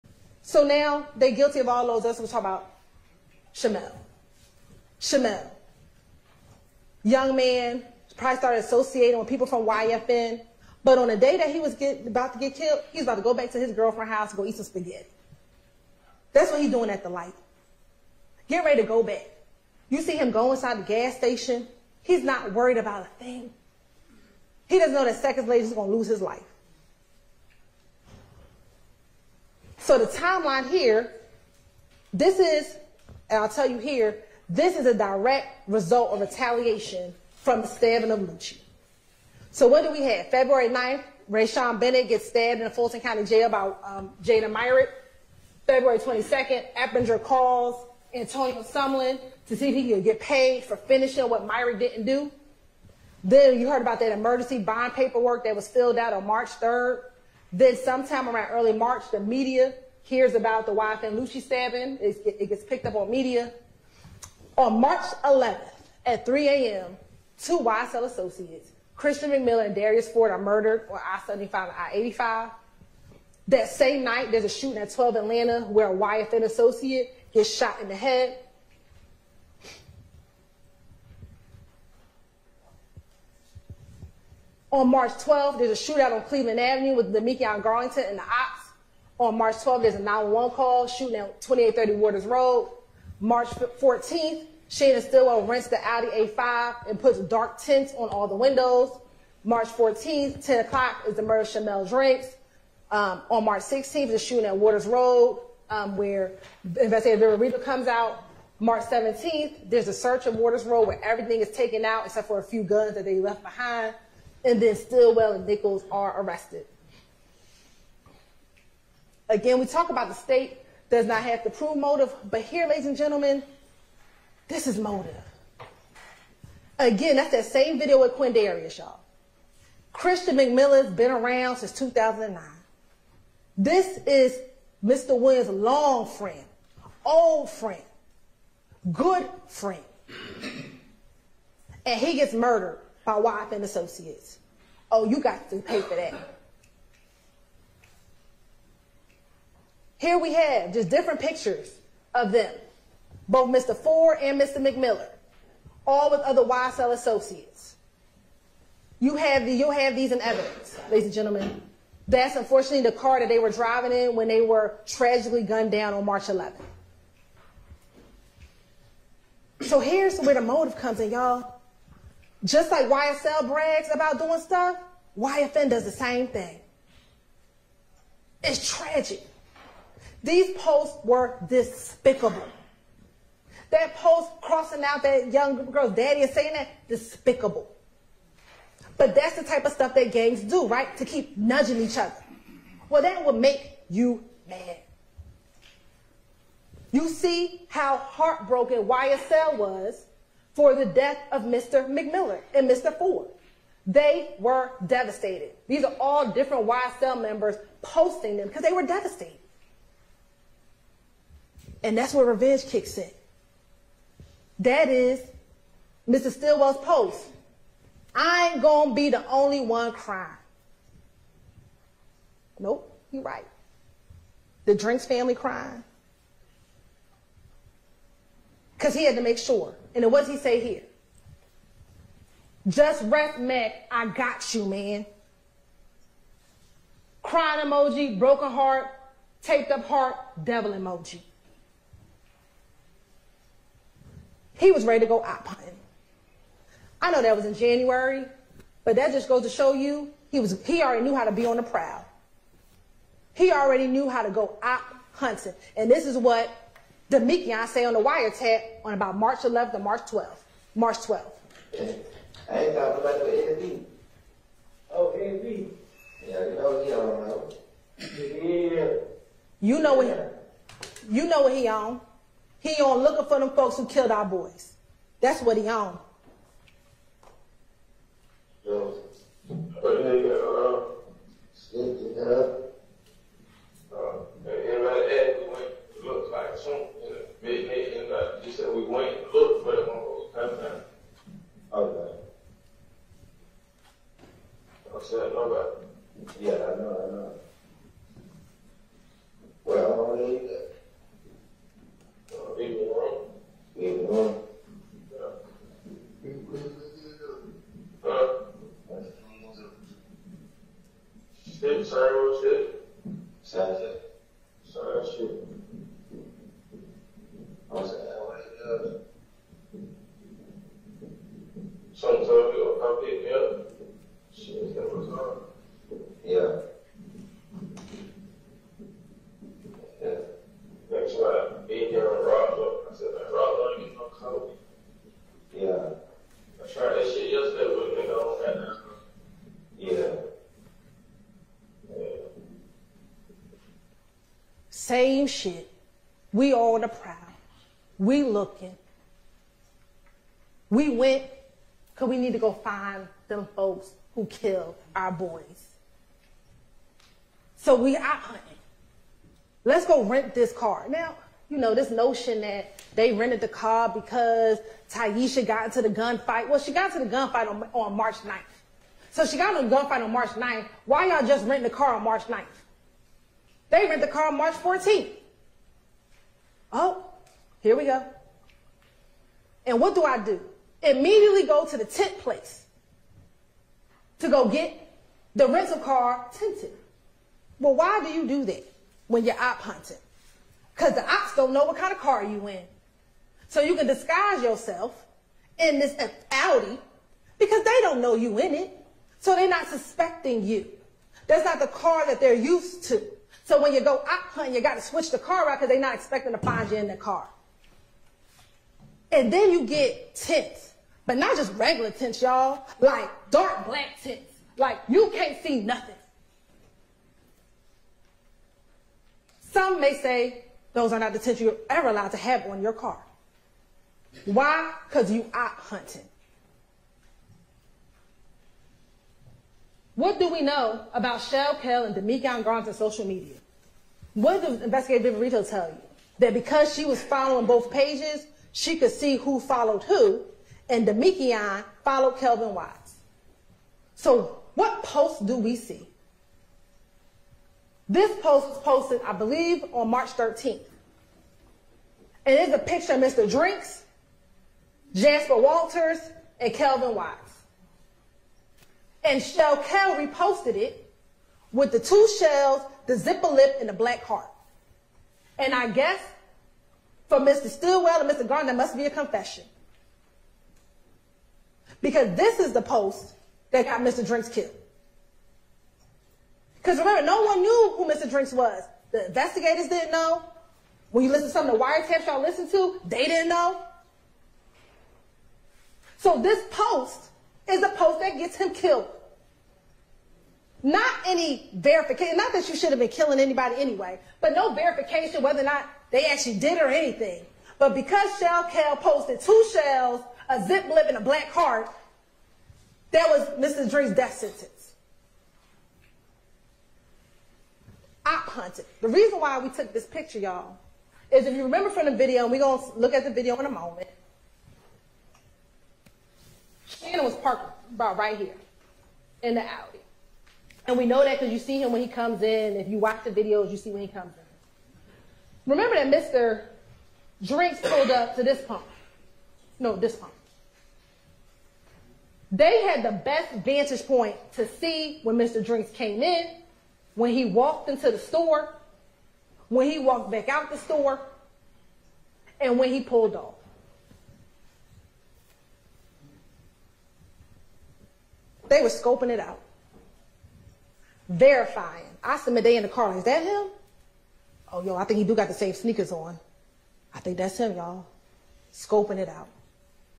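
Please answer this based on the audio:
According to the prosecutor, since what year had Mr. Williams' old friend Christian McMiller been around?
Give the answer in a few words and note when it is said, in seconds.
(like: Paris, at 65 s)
2009, at 131 s.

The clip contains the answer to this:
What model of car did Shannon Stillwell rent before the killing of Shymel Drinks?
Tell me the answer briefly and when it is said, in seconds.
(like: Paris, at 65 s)
Audi A5, at 95 s.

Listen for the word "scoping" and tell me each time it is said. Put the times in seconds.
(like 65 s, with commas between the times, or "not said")
548 s, 558 s.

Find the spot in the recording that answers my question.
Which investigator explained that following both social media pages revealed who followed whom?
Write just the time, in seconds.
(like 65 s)
435 s.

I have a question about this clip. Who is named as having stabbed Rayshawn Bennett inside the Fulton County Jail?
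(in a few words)
Jada Myrick.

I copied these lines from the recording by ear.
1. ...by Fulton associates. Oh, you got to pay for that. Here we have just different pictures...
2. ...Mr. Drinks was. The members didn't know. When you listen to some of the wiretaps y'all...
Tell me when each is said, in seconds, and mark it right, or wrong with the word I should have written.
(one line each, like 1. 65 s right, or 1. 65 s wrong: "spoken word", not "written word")
1. 143 s wrong: "YFN", not "Fulton"
2. 477 s wrong: "investigators", not "members".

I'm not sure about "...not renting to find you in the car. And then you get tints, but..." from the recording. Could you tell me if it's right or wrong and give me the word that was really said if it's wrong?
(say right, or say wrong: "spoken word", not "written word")
wrong: "expecting", not "renting".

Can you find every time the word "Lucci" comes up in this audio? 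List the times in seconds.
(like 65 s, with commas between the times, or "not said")
38 s, 61 s.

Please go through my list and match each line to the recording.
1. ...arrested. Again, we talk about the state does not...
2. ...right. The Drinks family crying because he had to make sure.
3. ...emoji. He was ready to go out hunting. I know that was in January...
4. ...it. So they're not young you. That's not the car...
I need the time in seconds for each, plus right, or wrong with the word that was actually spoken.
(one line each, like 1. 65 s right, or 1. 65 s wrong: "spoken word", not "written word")
1. 116 s right
2. 223 s right
3. 240 s right
4. 398 s wrong: "suspecting", not "young".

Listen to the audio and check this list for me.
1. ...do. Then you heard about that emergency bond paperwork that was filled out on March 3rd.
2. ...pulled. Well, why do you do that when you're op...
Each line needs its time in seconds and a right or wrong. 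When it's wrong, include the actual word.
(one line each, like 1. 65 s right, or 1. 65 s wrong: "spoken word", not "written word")
1. 52 s right
2. 386 s wrong: "tinted", not "pulled".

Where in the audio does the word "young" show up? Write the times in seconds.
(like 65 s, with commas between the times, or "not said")
7 s, 185 s.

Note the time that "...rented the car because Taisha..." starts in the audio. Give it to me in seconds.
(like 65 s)
363 s.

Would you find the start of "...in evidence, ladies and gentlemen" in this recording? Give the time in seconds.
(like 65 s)
160 s.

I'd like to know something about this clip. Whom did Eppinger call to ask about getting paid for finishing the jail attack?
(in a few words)
Antonio Sumlin.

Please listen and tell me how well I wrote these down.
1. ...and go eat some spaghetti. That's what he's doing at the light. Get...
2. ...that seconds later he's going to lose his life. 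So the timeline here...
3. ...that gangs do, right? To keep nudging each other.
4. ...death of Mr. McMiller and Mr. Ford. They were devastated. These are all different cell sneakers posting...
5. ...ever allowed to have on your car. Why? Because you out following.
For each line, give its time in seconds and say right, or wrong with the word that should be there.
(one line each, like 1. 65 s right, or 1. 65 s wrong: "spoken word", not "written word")
1. 14 s right
2. 25 s right
3. 189 s right
4. 200 s wrong: "members", not "sneakers"
5. 421 s wrong: "hunting", not "following".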